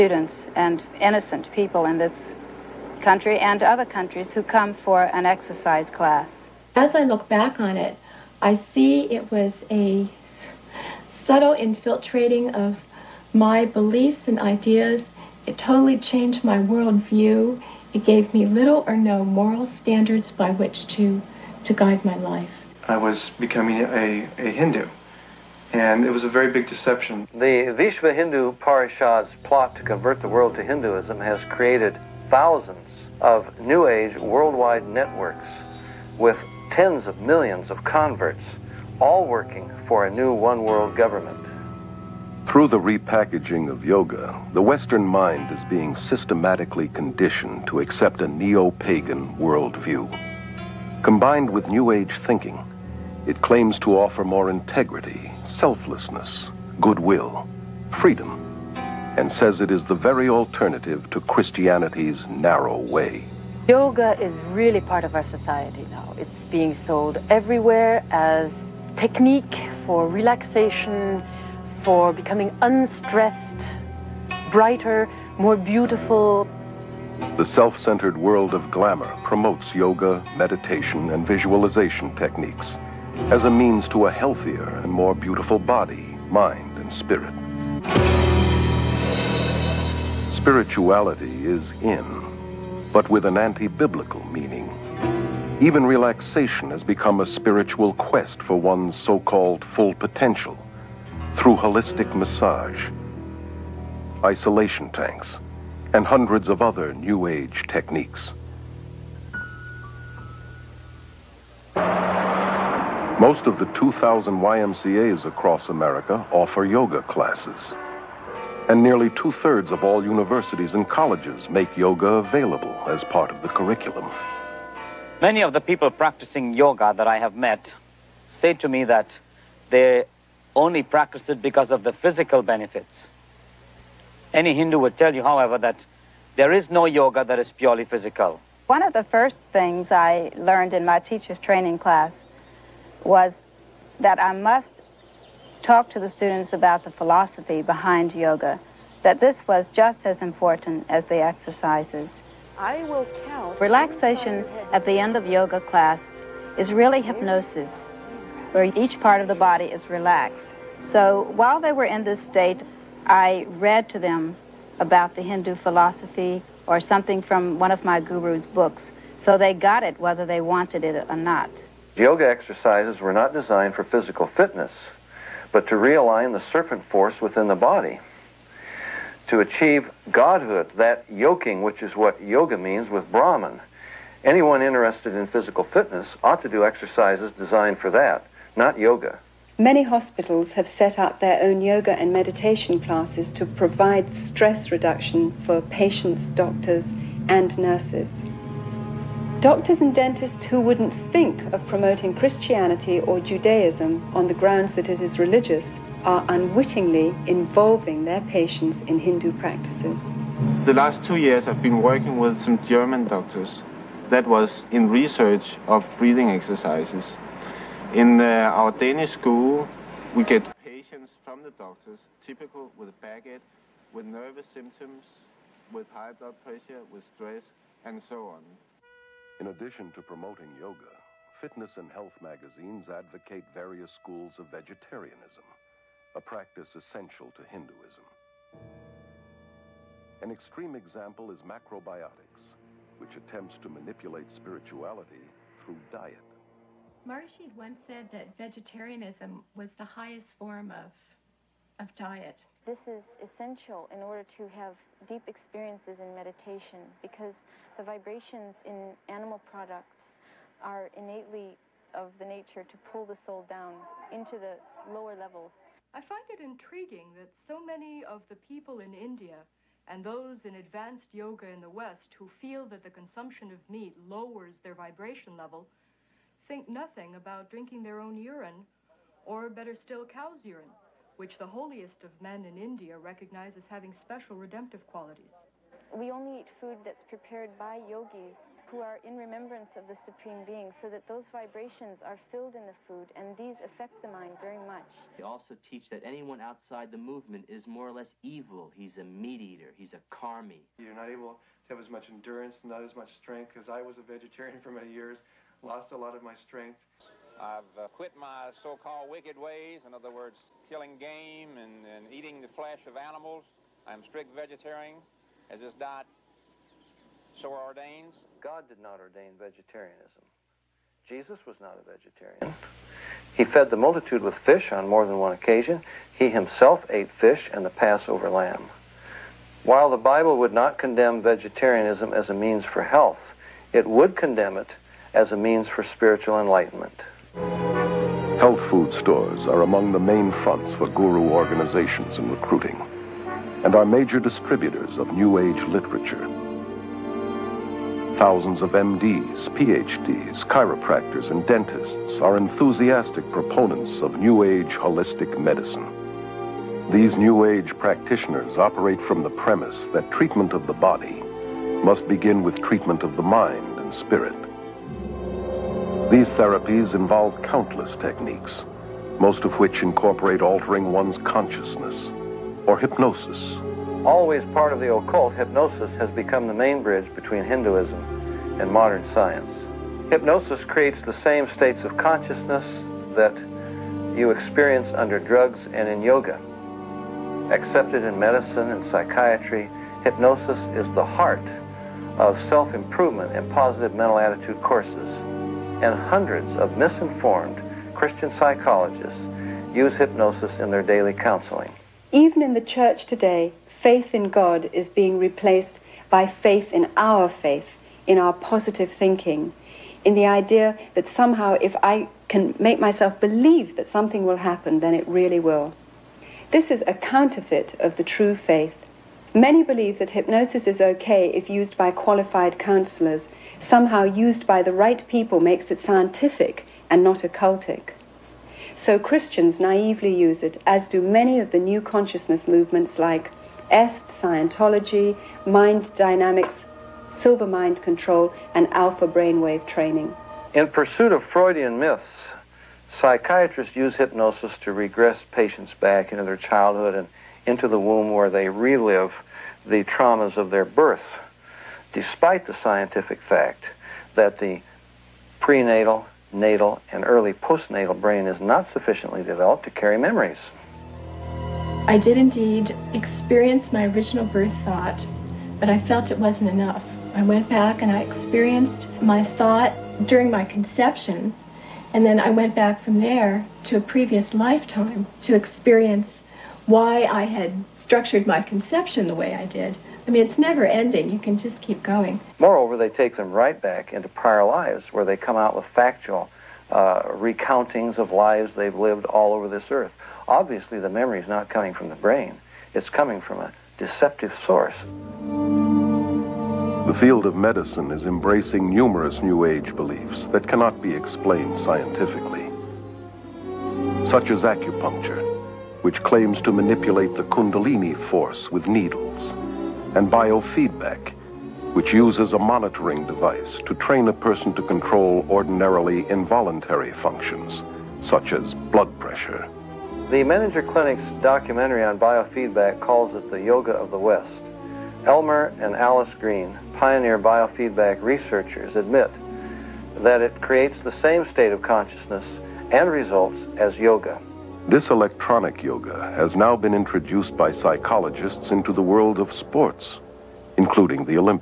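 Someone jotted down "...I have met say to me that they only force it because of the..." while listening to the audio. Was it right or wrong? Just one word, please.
wrong.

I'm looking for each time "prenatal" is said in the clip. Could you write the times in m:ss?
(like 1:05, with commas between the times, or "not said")
7:35.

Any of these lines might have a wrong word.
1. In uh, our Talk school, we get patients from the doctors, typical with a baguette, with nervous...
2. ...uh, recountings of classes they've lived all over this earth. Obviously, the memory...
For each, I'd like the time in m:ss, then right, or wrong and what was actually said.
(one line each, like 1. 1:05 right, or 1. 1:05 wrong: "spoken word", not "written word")
1. 3:37 wrong: "Danish", not "Talk"
2. 8:06 wrong: "lives", not "classes".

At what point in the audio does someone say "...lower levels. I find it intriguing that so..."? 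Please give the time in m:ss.
4:24.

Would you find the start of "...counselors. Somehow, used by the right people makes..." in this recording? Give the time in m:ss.
7:02.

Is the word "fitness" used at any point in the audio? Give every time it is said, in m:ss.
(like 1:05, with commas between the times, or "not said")
2:54, 3:05, 3:51.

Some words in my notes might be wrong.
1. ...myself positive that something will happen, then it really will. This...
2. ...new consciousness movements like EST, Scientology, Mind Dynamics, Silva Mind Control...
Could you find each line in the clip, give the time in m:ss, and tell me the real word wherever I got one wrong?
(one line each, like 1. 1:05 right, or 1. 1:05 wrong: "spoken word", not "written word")
1. 6:52 wrong: "believe", not "positive"
2. 7:11 right.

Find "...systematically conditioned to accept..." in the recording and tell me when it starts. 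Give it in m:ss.
0:45.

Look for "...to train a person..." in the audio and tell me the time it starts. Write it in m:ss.
8:33.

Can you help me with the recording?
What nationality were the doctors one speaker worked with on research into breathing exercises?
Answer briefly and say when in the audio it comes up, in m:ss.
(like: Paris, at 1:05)
German, at 3:32.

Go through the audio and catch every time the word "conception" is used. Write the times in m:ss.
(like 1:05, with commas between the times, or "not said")
7:50, 7:58.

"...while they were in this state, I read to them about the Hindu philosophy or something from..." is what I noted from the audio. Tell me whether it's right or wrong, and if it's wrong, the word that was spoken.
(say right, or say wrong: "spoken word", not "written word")
right.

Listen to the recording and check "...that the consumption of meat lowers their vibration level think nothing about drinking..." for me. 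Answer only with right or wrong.
right.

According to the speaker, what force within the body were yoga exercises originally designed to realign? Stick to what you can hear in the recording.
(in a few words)
Serpent force.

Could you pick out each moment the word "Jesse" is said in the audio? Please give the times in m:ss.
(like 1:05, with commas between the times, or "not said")
not said.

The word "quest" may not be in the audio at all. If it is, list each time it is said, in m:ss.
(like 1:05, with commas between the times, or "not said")
1:37.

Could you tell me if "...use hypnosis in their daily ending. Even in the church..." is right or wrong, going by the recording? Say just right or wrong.
wrong.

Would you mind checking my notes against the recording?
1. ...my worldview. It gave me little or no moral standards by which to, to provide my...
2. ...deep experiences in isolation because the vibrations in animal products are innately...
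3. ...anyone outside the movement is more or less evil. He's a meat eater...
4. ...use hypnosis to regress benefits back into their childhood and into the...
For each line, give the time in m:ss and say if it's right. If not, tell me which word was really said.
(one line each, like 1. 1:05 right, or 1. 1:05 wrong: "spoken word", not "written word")
1. 0:16 wrong: "guide", not "provide"
2. 4:15 wrong: "meditation", not "isolation"
3. 4:56 right
4. 7:23 wrong: "patients", not "benefits".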